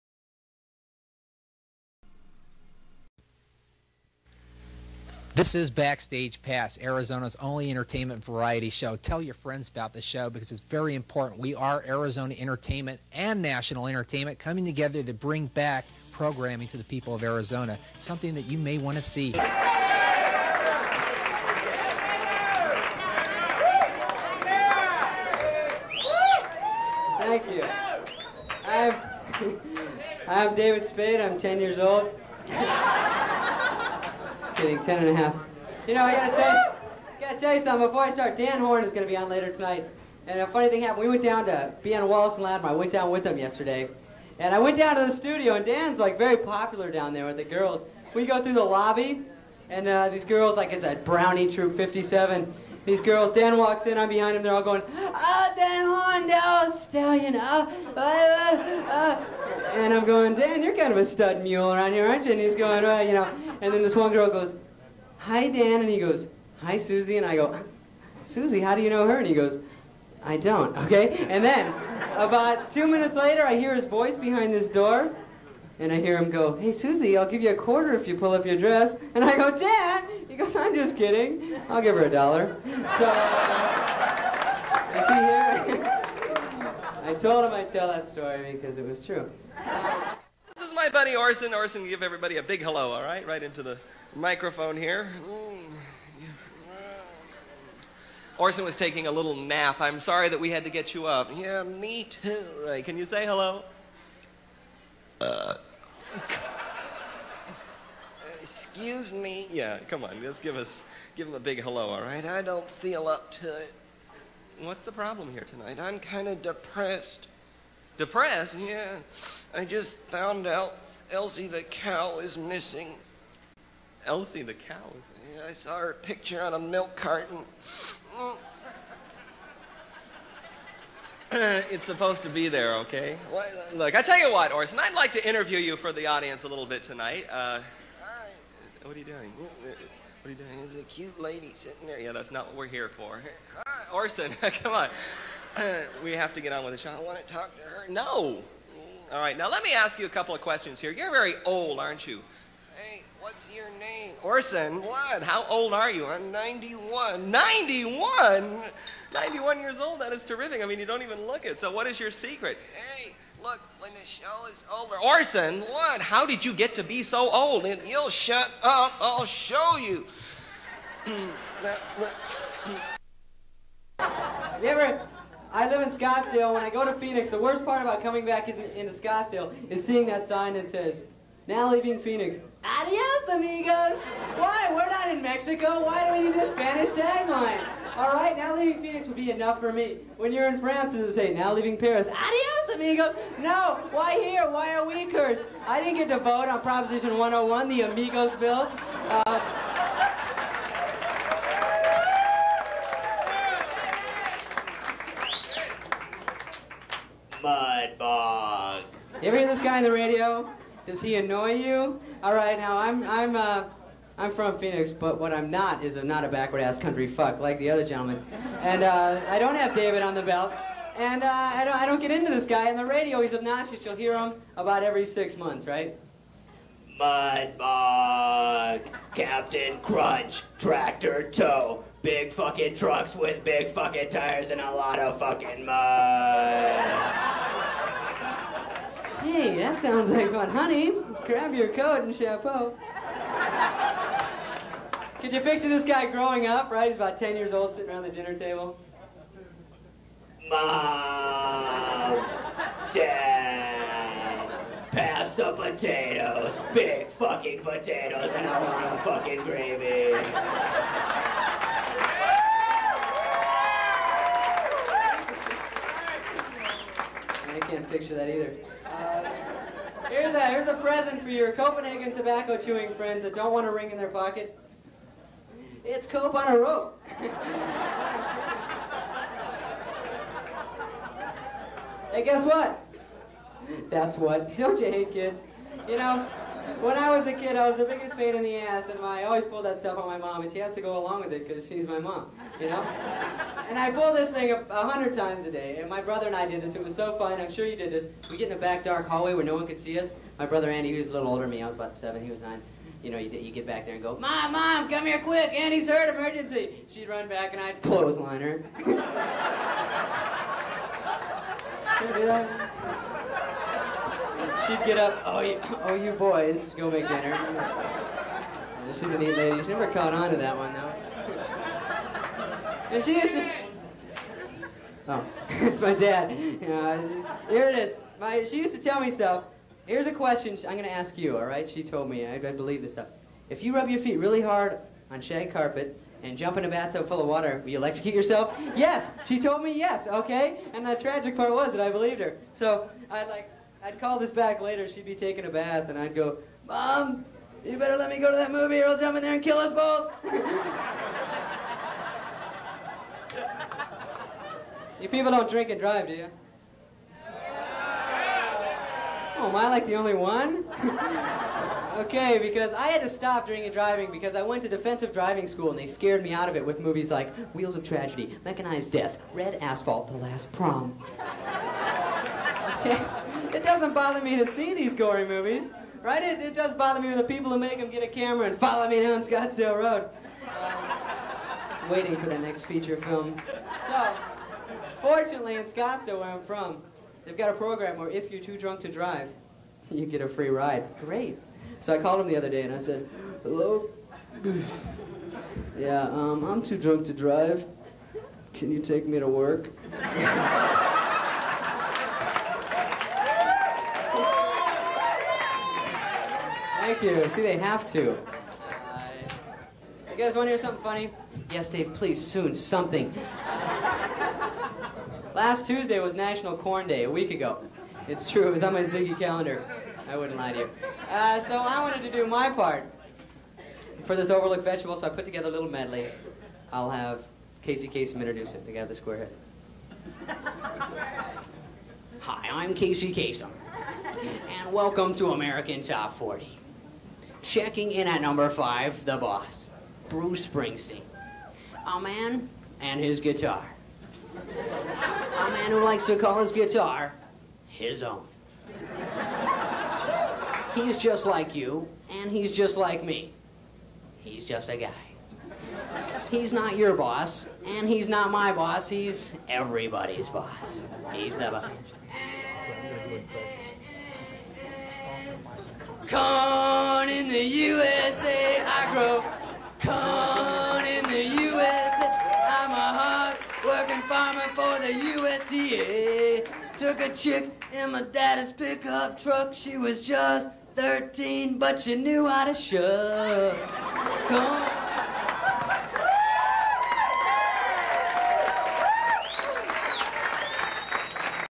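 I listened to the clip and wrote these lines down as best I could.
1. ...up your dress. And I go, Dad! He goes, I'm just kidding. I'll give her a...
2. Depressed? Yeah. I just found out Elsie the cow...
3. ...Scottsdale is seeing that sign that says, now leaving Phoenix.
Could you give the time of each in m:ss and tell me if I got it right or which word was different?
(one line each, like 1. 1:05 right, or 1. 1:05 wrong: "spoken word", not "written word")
1. 1:18 right
2. 1:57 right
3. 2:58 right.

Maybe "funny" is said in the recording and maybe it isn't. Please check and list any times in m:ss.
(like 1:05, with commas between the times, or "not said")
0:40, 6:50.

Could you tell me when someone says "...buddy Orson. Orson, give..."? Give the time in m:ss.
1:30.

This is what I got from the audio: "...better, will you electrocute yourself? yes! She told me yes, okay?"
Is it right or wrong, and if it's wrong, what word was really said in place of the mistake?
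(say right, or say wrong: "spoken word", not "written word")
wrong: "water", not "better".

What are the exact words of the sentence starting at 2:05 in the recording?
Yeah, I saw her picture on a milk carton.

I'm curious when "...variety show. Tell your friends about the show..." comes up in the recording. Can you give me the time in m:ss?
0:08.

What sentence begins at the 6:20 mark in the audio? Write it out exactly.
Um, just waiting for the next feature film.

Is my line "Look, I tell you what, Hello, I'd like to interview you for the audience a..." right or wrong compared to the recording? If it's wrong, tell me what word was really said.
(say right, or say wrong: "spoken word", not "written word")
wrong: "Orson", not "Hello".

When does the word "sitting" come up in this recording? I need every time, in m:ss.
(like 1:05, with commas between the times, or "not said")
2:21, 4:07.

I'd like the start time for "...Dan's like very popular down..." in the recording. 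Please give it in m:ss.
0:45.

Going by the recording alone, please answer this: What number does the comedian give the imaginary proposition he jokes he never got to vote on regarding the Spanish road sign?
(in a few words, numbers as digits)
101.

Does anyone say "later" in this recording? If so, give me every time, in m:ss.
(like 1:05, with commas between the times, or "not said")
0:39, 1:13, 5:44.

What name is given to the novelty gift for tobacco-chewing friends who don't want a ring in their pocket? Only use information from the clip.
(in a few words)
Cope on a rope.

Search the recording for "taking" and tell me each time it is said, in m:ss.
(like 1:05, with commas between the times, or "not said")
1:38, 5:45.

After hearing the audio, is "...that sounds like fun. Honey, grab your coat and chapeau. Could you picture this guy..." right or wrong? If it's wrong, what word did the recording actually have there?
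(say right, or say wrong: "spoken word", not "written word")
right.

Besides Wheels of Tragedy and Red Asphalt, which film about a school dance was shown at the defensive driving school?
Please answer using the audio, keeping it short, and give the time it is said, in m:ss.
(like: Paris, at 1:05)
The Last Prom, at 6:10.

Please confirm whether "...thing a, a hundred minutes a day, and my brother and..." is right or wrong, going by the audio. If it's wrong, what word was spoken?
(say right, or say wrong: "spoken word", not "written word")
wrong: "times", not "minutes".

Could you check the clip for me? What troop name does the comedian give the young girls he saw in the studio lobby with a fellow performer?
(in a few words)
Brownie Troop 57.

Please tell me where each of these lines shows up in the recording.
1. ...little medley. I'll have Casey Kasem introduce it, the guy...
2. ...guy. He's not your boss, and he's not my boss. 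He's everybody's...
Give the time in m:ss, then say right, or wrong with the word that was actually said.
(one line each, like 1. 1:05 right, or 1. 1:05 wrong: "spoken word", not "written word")
1. 7:05 right
2. 7:34 right.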